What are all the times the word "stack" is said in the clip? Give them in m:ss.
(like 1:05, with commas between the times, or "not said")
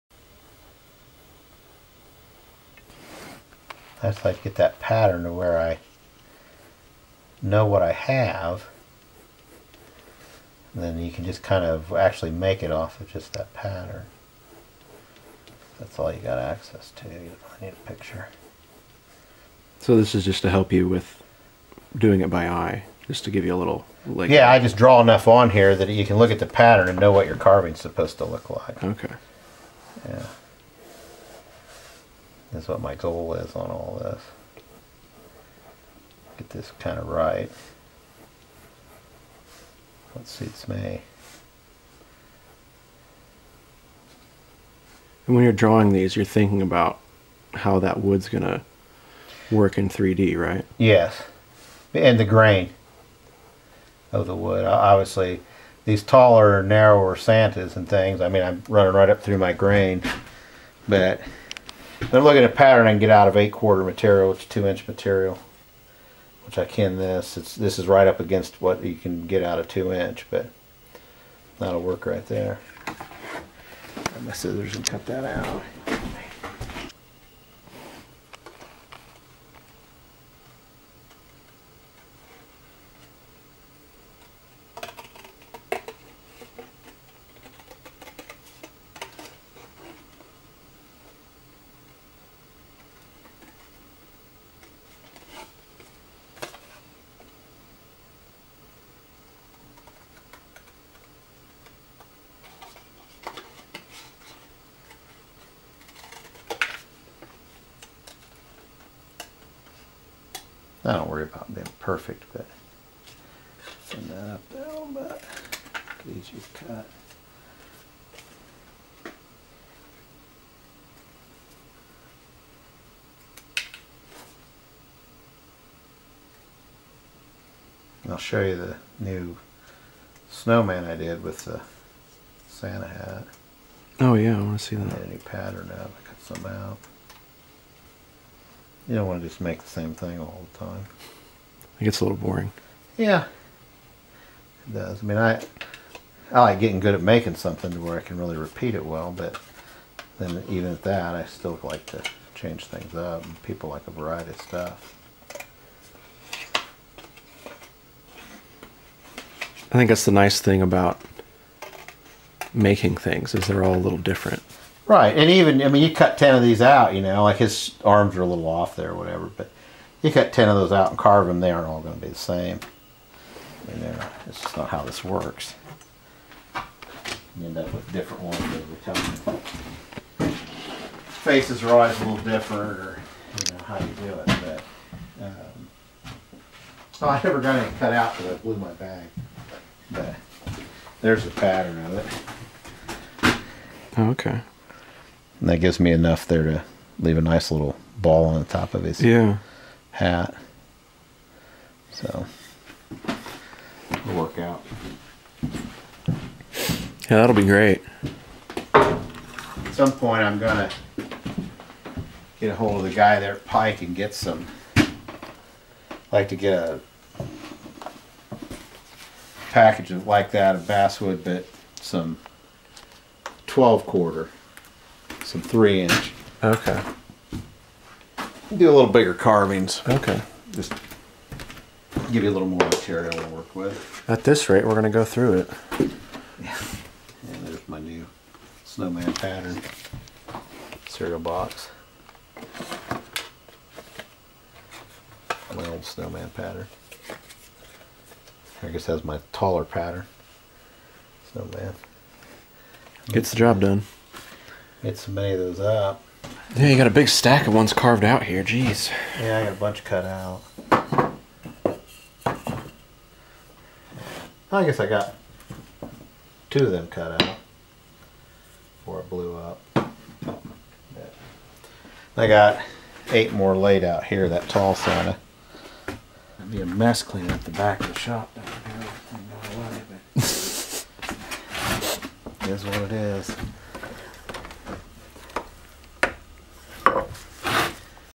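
4:17.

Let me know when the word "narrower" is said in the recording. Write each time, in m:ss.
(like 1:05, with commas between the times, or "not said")
0:56.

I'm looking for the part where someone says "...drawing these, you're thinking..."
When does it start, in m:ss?
0:45.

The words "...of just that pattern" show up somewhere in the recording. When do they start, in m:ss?
0:12.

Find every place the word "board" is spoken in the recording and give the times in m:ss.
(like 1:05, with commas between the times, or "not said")
not said.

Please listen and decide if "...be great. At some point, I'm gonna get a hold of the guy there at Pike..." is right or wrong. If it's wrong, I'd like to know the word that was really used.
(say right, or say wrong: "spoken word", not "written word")
right.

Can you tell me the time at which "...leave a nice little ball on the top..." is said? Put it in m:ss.
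3:16.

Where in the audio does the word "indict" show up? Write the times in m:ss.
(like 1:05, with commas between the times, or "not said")
not said.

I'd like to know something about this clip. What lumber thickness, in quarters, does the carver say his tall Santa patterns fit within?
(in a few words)
8 quarter.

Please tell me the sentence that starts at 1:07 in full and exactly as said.
It's, this is right up against what you can get out of 2 inch, but that'll work right there.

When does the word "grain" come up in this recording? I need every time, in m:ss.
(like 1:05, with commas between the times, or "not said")
0:52, 0:59.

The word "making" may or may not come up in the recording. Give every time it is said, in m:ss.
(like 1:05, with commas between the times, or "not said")
2:27, 2:42.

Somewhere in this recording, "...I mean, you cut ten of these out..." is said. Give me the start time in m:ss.
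2:45.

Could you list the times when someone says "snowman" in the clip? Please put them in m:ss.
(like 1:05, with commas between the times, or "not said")
2:10, 3:58, 4:05, 4:11.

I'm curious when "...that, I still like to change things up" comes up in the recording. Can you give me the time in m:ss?
2:30.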